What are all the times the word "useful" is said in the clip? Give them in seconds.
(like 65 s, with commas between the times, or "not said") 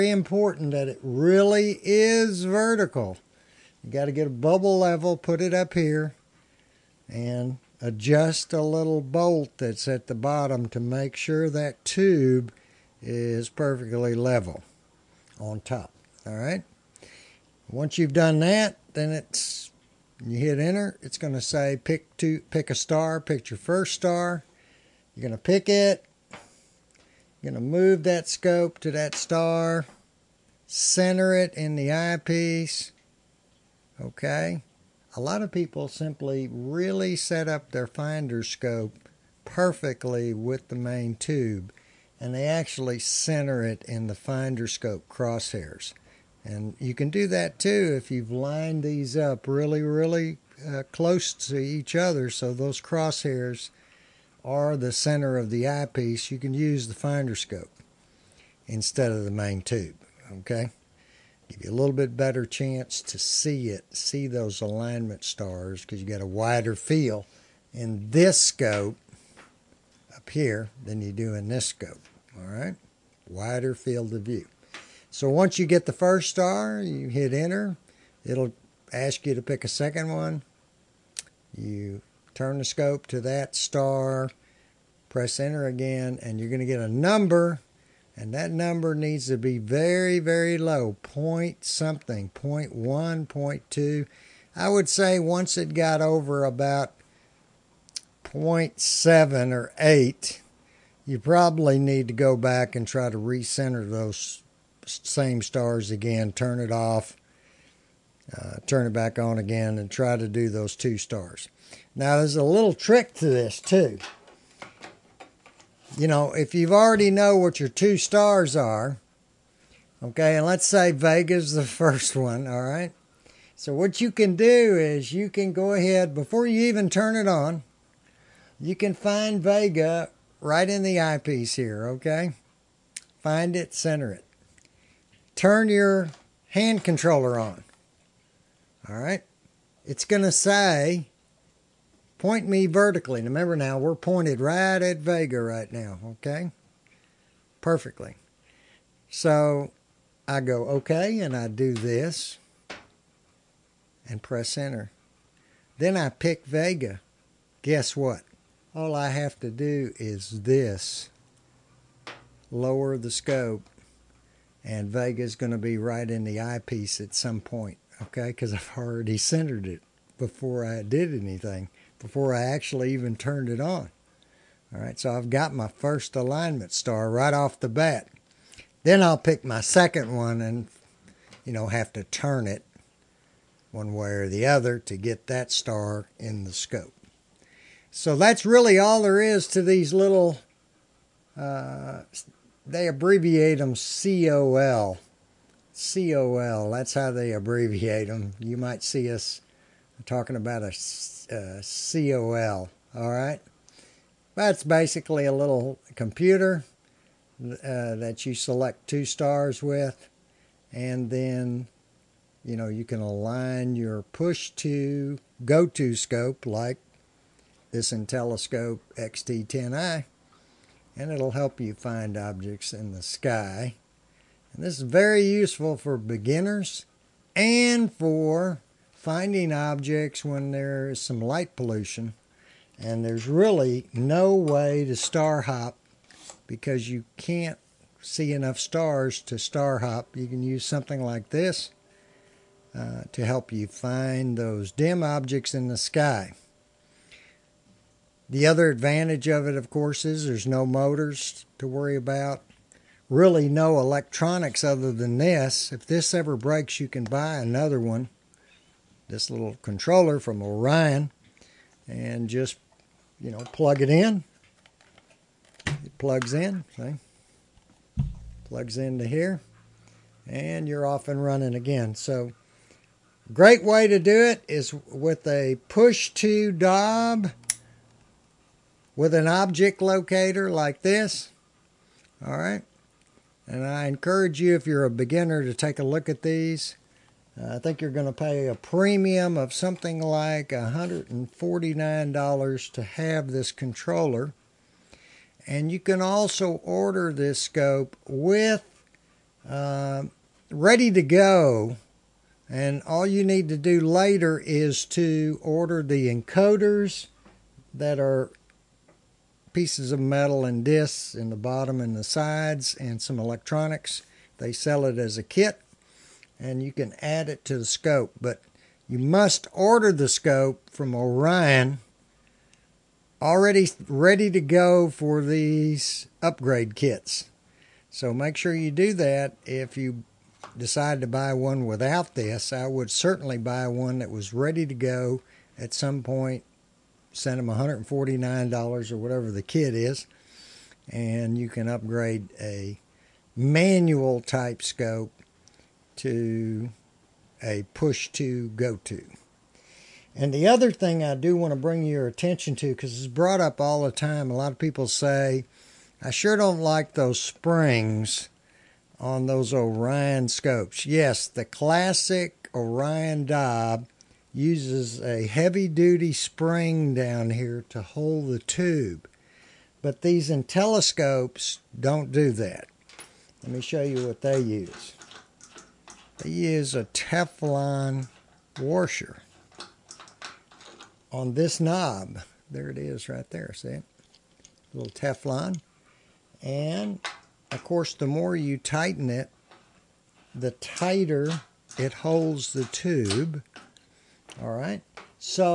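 225 s.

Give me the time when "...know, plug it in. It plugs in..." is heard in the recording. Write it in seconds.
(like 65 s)
263 s.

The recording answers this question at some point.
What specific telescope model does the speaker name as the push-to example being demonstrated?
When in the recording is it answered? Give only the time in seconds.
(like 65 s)
217 s.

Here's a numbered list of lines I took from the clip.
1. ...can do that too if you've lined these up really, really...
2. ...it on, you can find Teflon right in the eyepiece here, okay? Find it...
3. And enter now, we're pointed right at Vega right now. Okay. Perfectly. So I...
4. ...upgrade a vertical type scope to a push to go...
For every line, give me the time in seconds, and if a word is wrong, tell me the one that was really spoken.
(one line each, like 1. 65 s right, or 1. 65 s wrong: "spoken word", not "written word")
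1. 46 s right
2. 127 s wrong: "Vega", not "Teflon"
3. 143 s wrong: "remember", not "enter"
4. 341 s wrong: "manual", not "vertical".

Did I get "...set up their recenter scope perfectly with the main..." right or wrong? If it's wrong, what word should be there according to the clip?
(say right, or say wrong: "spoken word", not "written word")
wrong: "finder", not "recenter".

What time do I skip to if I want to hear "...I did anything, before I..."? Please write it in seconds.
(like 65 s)
170 s.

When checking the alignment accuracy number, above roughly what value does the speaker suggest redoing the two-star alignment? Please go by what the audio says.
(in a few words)
0.7.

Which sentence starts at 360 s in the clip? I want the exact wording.
Yes, the classic Orion Dob uses a heavy duty spring down here to hold the tube.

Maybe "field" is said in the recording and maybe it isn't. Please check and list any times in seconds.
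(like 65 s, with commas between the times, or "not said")
66 s, 73 s.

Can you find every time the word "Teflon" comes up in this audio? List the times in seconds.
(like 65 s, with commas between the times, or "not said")
376 s, 384 s.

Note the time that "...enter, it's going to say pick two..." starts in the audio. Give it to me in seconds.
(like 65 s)
20 s.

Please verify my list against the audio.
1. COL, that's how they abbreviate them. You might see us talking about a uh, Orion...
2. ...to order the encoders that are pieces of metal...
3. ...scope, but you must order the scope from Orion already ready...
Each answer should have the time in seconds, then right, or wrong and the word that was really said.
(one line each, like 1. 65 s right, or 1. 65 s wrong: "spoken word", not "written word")
1. 195 s wrong: "COL", not "Orion"
2. 304 s right
3. 317 s right.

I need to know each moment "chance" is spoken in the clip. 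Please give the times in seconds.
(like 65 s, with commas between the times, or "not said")
62 s.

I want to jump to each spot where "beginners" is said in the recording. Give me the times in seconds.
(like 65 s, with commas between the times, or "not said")
225 s, 284 s.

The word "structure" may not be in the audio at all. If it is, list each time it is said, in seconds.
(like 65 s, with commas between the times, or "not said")
not said.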